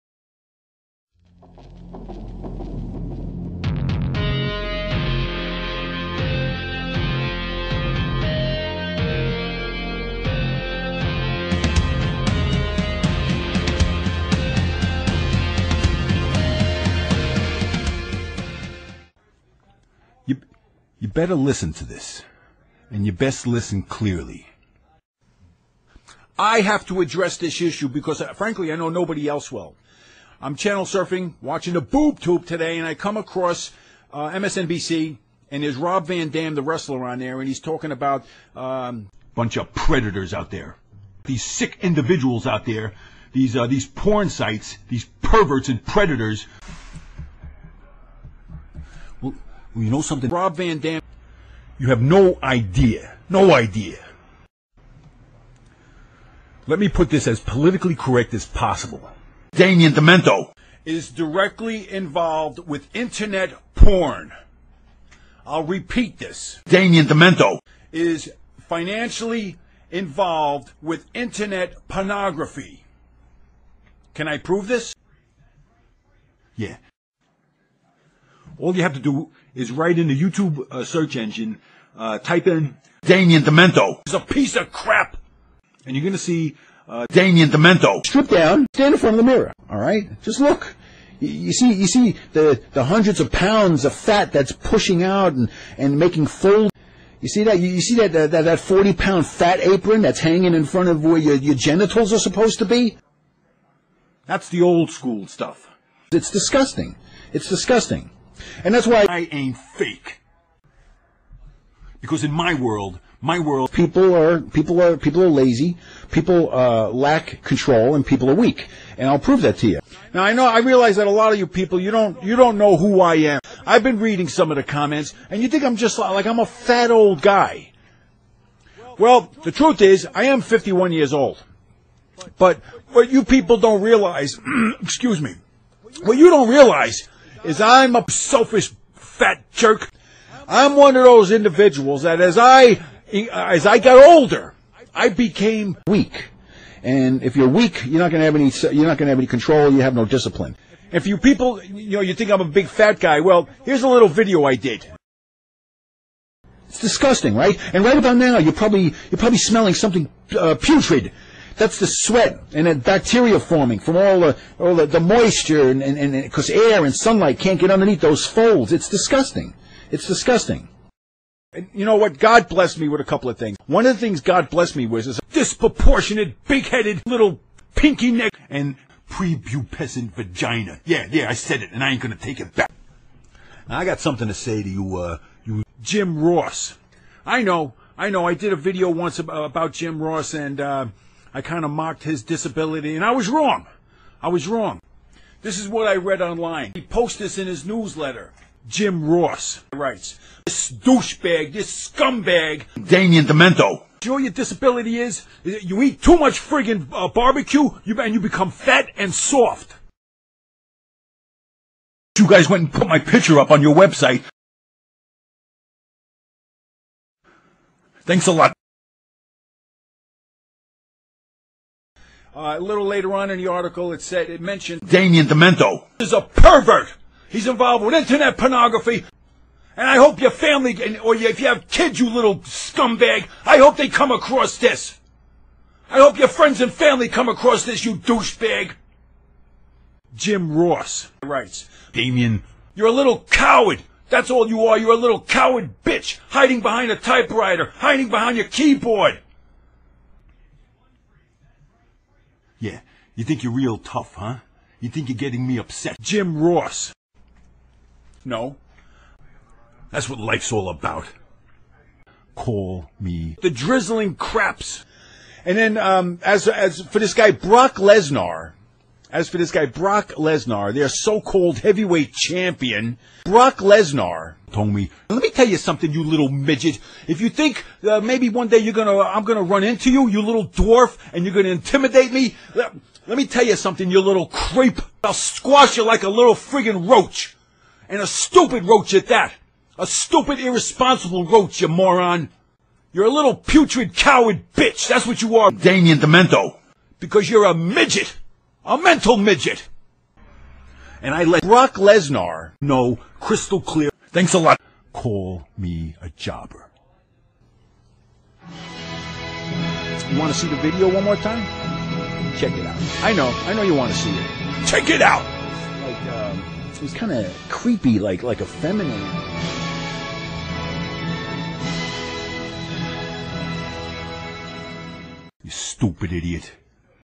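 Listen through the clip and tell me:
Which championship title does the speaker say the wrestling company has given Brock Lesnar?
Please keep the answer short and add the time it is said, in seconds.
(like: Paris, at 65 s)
Heavyweight champion, at 271 s.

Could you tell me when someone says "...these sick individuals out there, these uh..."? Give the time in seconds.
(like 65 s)
41 s.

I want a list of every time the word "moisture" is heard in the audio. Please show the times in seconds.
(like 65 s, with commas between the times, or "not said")
164 s.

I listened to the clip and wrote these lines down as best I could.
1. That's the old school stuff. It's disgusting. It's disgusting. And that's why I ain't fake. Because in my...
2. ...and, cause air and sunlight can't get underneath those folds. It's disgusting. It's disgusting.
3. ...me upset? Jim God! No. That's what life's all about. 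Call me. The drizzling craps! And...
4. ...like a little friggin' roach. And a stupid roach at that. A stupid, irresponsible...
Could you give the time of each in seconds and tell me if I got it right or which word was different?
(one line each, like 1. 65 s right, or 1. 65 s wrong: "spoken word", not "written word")
1. 104 s right
2. 166 s right
3. 255 s wrong: "Ross", not "God"
4. 285 s right.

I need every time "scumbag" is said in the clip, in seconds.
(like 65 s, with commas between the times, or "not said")
201 s, 232 s.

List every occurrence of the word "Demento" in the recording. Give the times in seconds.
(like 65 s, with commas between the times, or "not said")
59 s, 67 s, 83 s, 87 s, 203 s, 225 s, 295 s.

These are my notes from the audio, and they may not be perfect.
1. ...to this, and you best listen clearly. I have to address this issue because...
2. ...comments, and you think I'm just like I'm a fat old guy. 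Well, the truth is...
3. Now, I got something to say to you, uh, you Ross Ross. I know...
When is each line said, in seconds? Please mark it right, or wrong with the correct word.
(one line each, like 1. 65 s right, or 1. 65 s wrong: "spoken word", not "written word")
1. 21 s right
2. 124 s right
3. 183 s wrong: "Jim", not "Ross".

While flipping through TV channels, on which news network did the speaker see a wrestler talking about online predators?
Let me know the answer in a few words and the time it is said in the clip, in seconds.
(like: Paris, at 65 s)
MSNBC, at 34 s.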